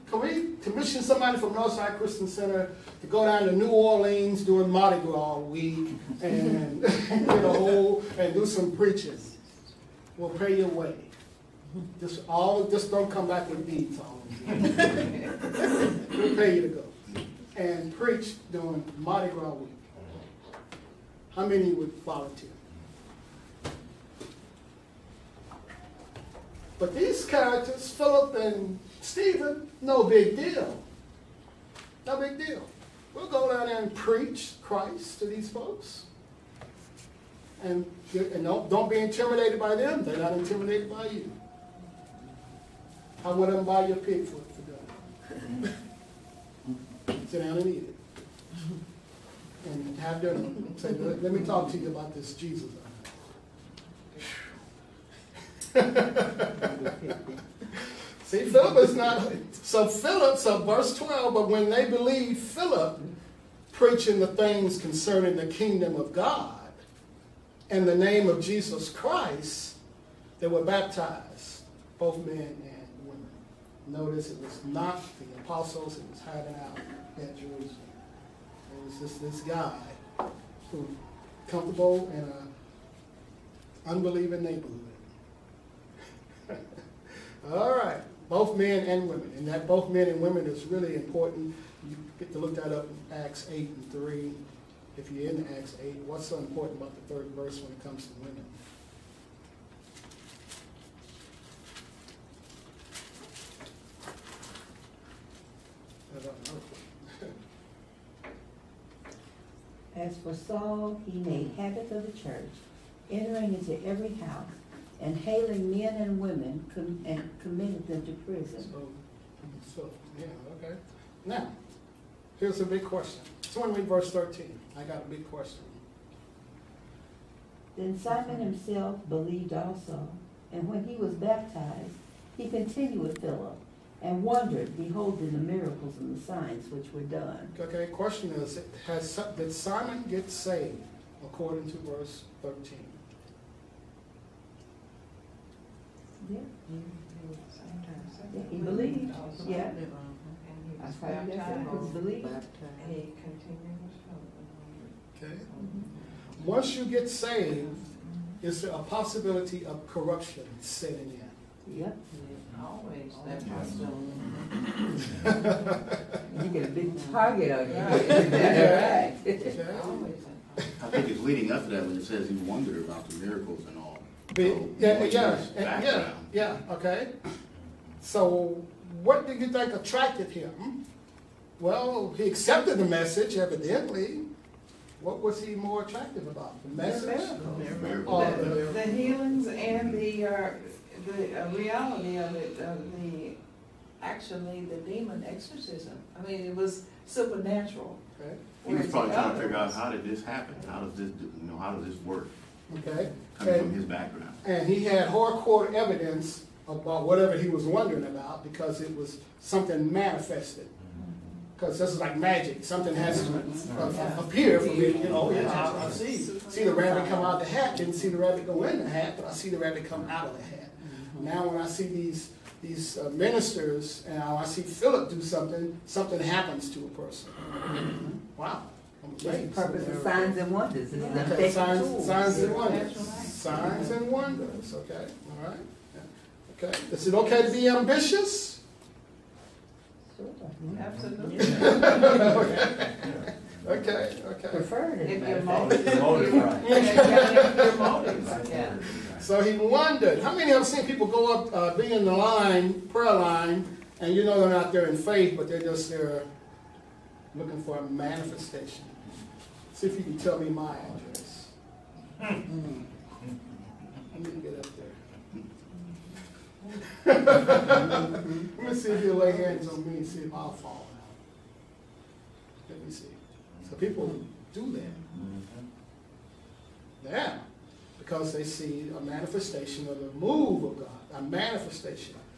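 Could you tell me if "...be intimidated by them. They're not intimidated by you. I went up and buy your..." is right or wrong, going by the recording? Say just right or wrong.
right.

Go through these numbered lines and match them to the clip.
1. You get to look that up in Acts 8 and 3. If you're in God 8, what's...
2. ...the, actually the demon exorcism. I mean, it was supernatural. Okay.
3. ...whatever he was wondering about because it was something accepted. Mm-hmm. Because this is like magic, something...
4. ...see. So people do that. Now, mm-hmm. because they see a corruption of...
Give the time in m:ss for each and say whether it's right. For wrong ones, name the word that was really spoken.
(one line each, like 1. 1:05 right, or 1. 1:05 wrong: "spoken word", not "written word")
1. 1:31 wrong: "Acts", not "God"
2. 3:12 right
3. 3:27 wrong: "manifested", not "accepted"
4. 4:32 wrong: "manifestation", not "corruption".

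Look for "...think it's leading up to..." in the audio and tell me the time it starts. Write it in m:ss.
2:50.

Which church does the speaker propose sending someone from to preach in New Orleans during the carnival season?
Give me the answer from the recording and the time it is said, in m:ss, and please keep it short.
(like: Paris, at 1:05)
Northside Christian Center, at 0:01.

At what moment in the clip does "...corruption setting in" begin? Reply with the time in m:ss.
2:39.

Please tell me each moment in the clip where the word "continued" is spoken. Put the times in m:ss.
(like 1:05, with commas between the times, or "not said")
2:12, 2:33.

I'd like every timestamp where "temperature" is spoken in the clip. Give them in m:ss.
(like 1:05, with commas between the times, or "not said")
not said.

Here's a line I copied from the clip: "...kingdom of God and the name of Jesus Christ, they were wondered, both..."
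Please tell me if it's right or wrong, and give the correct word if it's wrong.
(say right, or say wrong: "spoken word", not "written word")
wrong: "baptized", not "wondered".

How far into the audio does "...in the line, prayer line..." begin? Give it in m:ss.
4:11.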